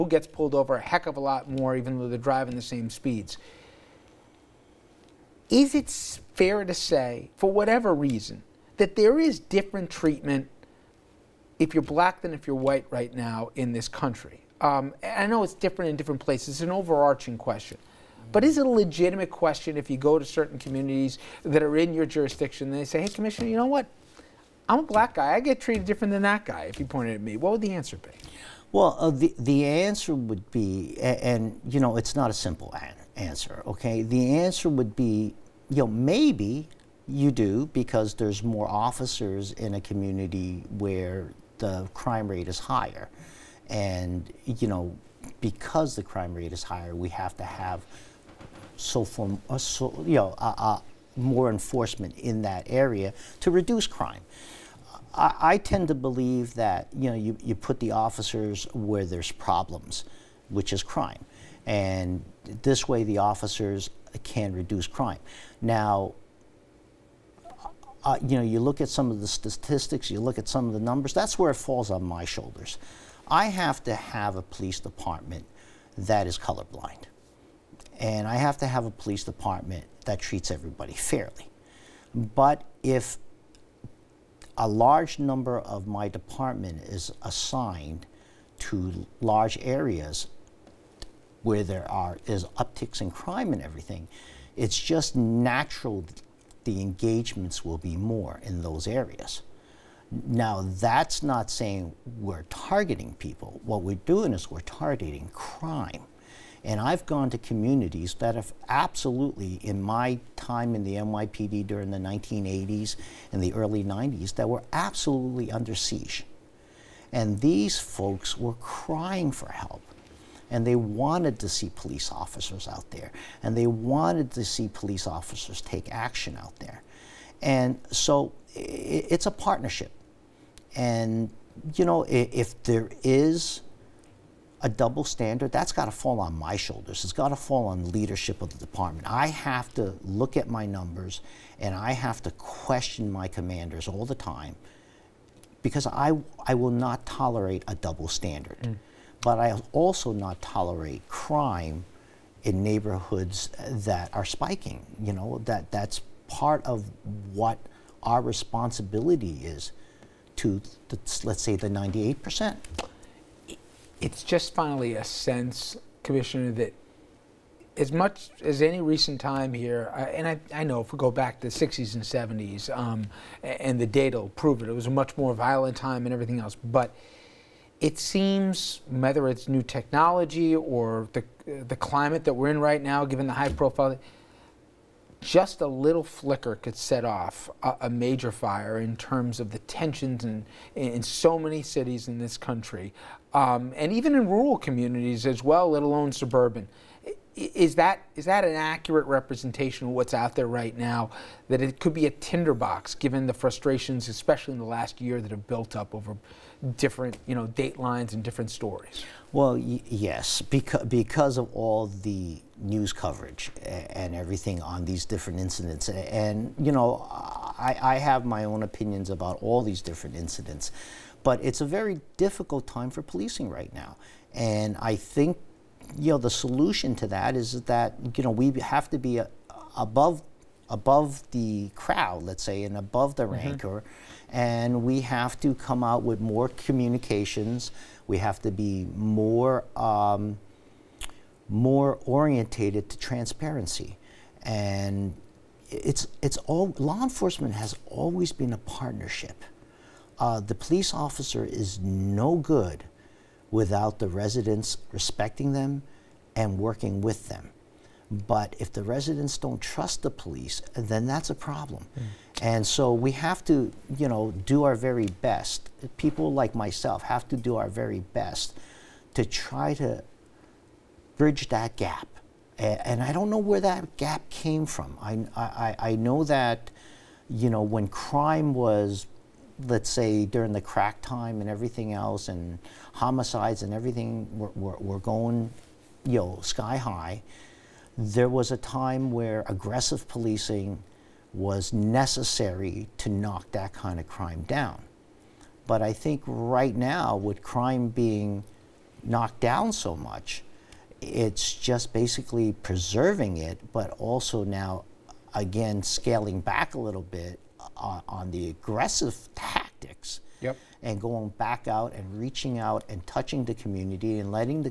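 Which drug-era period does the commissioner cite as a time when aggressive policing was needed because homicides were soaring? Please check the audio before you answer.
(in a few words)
crack time.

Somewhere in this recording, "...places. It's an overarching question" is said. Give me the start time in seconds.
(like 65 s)
16 s.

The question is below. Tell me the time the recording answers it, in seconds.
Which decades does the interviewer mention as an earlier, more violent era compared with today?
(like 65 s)
171 s.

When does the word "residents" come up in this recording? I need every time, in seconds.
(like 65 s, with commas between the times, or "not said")
254 s, 258 s.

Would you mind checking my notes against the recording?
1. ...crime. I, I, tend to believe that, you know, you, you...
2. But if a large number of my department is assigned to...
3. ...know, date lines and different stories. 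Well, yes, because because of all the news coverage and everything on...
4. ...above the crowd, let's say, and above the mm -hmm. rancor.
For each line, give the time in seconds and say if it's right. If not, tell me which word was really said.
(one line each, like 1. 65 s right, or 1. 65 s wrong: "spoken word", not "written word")
1. 53 s right
2. 82 s right
3. 207 s right
4. 230 s right.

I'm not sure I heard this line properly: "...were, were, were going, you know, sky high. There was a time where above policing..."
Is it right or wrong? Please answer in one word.
wrong.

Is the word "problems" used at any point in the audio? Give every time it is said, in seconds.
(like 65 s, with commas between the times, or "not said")
59 s, 261 s.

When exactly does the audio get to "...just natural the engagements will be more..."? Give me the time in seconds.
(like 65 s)
94 s.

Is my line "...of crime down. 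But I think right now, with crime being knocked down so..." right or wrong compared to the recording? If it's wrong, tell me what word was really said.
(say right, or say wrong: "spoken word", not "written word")
right.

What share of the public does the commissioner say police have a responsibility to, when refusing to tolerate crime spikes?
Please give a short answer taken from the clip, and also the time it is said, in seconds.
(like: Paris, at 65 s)
98%, at 161 s.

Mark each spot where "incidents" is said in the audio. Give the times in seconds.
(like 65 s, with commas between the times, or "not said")
215 s, 220 s.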